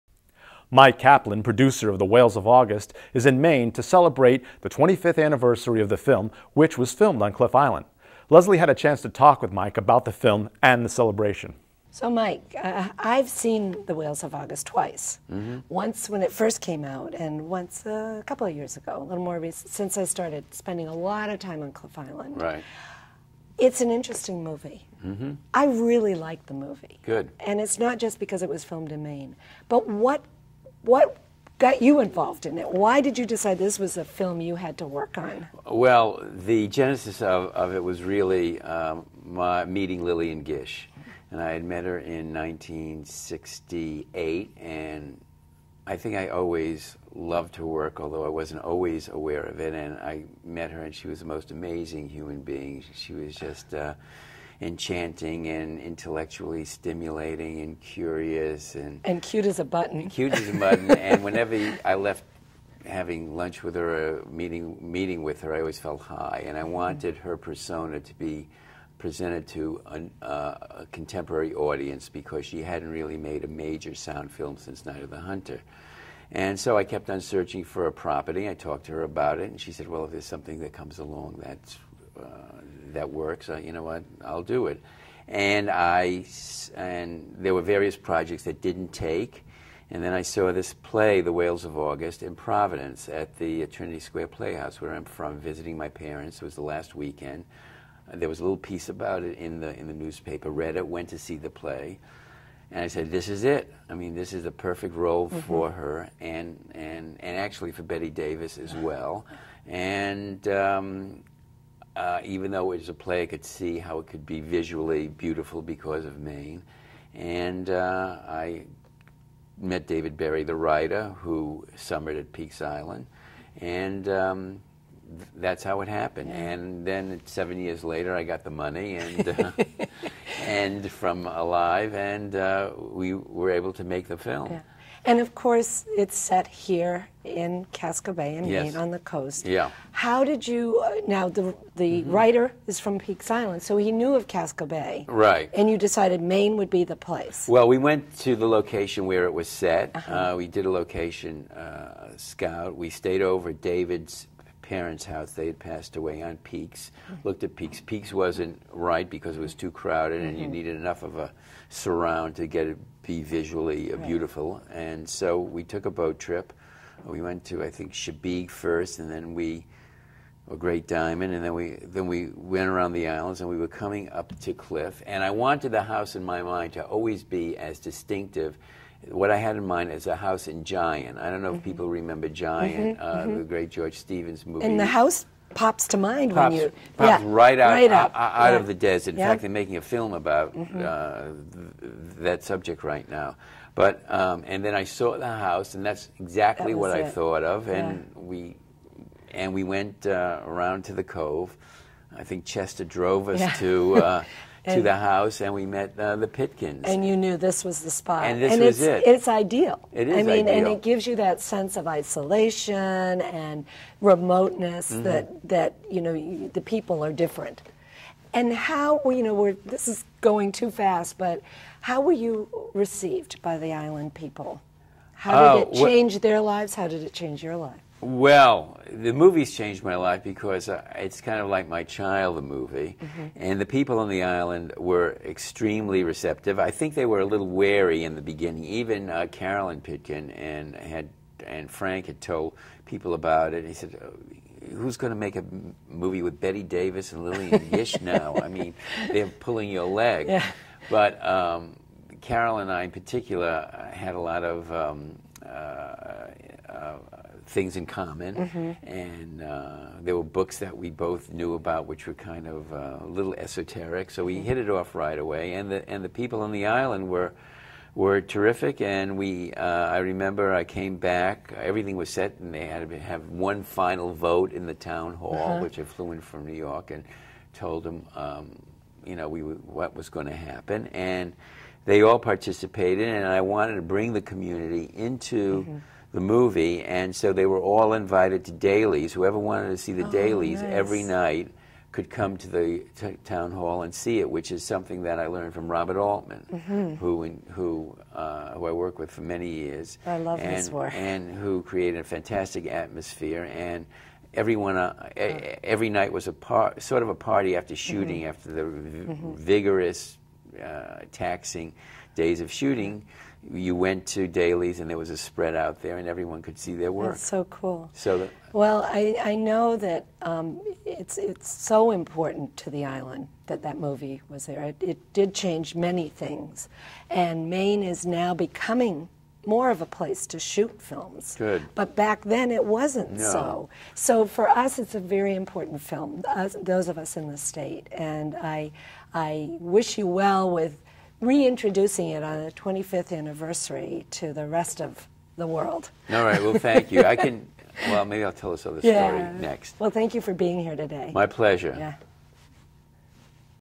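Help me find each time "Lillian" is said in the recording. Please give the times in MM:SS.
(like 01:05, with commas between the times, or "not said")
00:40, 04:07.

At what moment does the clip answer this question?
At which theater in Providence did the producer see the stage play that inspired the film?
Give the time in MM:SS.
01:33.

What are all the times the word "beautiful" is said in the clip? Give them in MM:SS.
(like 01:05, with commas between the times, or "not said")
01:55, 02:44.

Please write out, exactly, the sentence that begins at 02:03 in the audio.
And um, th- that's how it happened.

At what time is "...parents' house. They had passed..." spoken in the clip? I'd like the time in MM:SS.
02:34.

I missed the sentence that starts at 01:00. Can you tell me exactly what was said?
and whenever I left having lunch with her, uh, meeting meeting with her, I always felt high, and I mm-hmm.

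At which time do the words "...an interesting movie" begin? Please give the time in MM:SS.
00:23.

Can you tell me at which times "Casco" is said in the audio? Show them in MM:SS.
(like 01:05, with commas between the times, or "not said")
02:17, 02:24.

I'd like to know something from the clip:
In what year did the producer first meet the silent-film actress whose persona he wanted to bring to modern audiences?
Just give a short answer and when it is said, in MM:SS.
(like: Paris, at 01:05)
1968, at 00:42.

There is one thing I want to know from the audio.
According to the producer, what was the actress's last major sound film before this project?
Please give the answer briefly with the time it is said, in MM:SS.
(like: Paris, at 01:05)
Night of the Hunter, at 01:14.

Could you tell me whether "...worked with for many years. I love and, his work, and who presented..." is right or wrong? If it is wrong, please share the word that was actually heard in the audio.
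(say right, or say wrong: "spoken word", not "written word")
wrong: "created", not "presented".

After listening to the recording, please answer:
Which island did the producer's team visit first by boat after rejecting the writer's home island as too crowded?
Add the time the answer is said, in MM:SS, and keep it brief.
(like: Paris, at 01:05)
Chebeague, at 02:48.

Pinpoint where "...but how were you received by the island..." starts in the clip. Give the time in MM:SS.
03:41.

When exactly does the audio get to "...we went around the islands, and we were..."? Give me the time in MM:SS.
02:52.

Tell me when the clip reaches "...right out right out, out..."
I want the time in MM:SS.
03:07.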